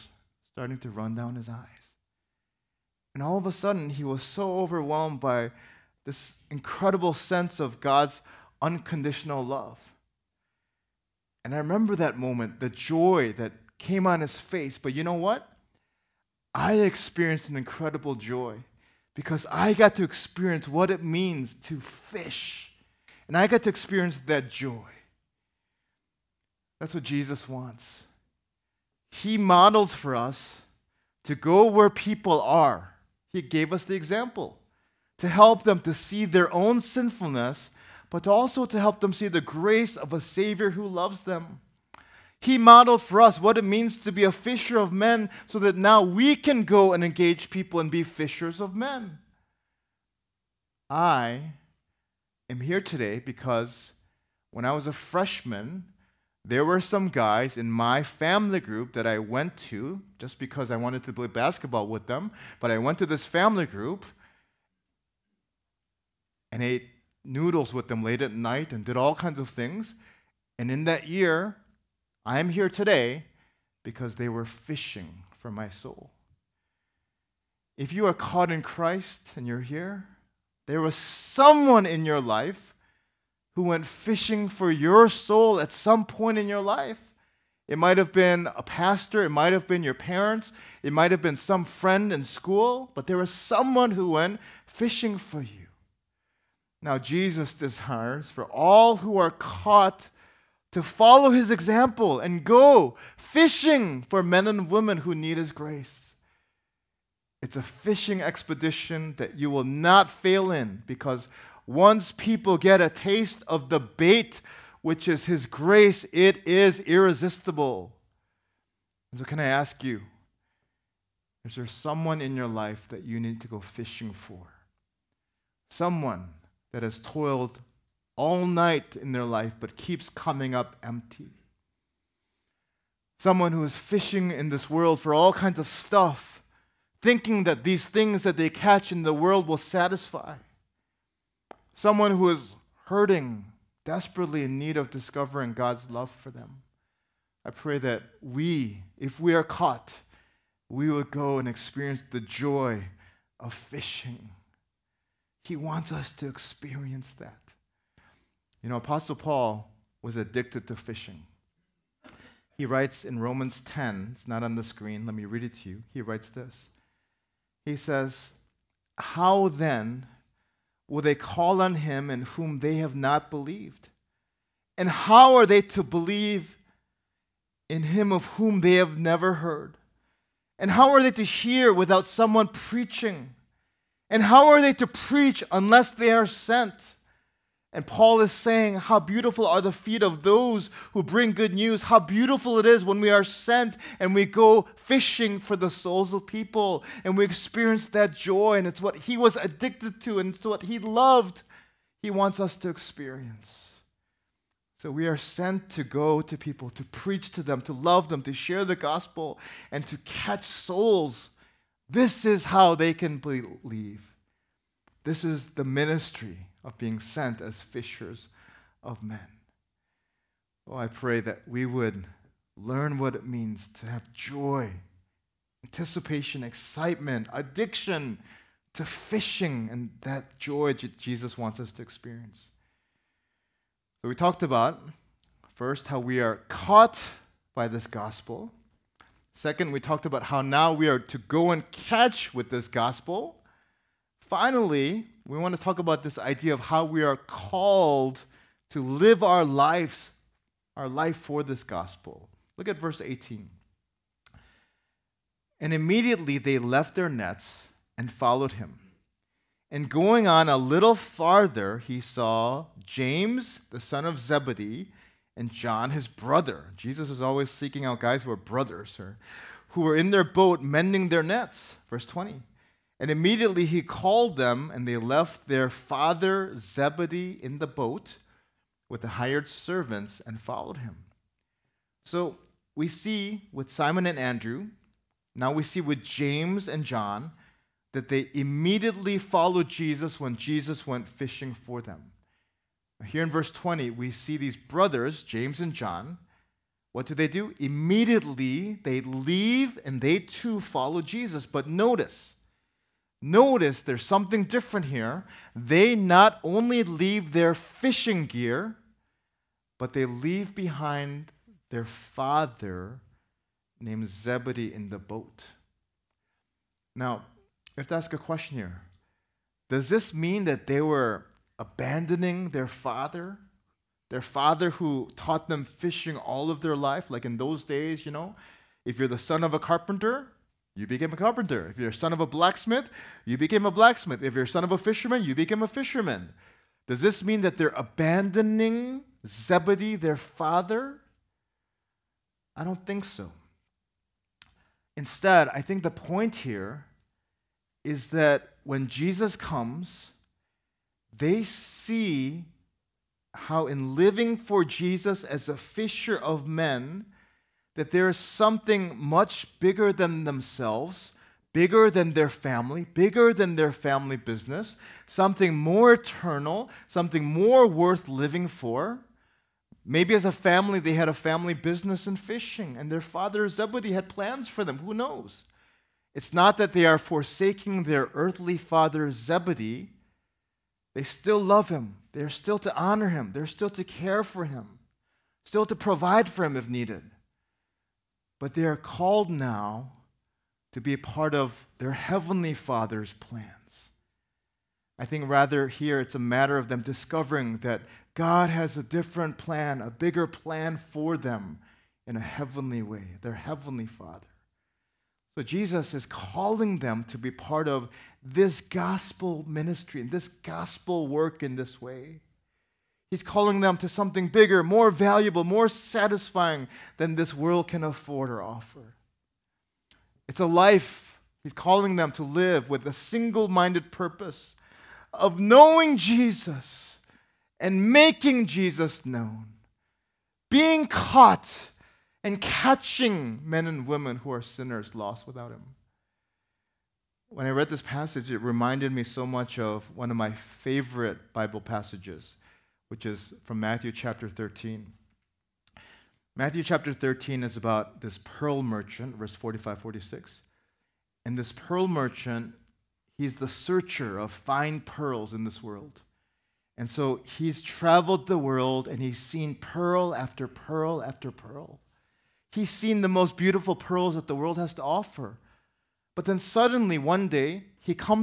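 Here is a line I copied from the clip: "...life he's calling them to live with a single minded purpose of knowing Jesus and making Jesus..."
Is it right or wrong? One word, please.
right.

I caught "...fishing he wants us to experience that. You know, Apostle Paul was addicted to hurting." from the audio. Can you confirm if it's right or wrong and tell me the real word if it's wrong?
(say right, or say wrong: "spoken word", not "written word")
wrong: "fishing", not "hurting".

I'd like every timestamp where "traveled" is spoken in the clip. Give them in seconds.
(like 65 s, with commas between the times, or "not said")
457 s.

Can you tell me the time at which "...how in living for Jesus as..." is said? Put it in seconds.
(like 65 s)
353 s.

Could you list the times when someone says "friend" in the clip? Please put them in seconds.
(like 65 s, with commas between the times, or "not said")
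91 s.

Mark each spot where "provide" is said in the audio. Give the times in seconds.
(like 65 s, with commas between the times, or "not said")
385 s.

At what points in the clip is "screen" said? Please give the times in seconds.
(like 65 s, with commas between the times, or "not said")
164 s.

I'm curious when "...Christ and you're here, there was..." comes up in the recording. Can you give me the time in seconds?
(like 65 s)
78 s.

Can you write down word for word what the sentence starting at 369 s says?
Maybe as a family, they had a family business in fishing, and their father Zebedee had plans for them.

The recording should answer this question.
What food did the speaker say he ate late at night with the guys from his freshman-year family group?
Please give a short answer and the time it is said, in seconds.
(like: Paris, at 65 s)
Noodles, at 67 s.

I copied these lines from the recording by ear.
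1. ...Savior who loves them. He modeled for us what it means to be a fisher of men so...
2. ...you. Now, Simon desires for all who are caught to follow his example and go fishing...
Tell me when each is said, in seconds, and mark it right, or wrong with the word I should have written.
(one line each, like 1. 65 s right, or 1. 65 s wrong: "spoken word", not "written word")
1. 40 s right
2. 95 s wrong: "Jesus", not "Simon".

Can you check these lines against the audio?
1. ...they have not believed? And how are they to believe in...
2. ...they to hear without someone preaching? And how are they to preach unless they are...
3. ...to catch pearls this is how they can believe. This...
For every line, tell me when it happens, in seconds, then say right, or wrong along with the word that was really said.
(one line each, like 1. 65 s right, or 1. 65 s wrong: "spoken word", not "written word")
1. 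172 s right
2. 181 s right
3. 209 s wrong: "souls", not "pearls".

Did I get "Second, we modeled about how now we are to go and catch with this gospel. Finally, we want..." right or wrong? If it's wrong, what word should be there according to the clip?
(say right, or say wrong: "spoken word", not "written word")
wrong: "talked", not "modeled".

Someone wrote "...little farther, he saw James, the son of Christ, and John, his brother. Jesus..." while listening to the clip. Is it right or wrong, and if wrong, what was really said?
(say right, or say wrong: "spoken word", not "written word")
wrong: "Zebedee", not "Christ".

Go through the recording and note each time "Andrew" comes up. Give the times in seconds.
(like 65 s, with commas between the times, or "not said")
284 s.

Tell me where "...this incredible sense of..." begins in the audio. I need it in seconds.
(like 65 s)
6 s.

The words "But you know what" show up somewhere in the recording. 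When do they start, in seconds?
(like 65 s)
14 s.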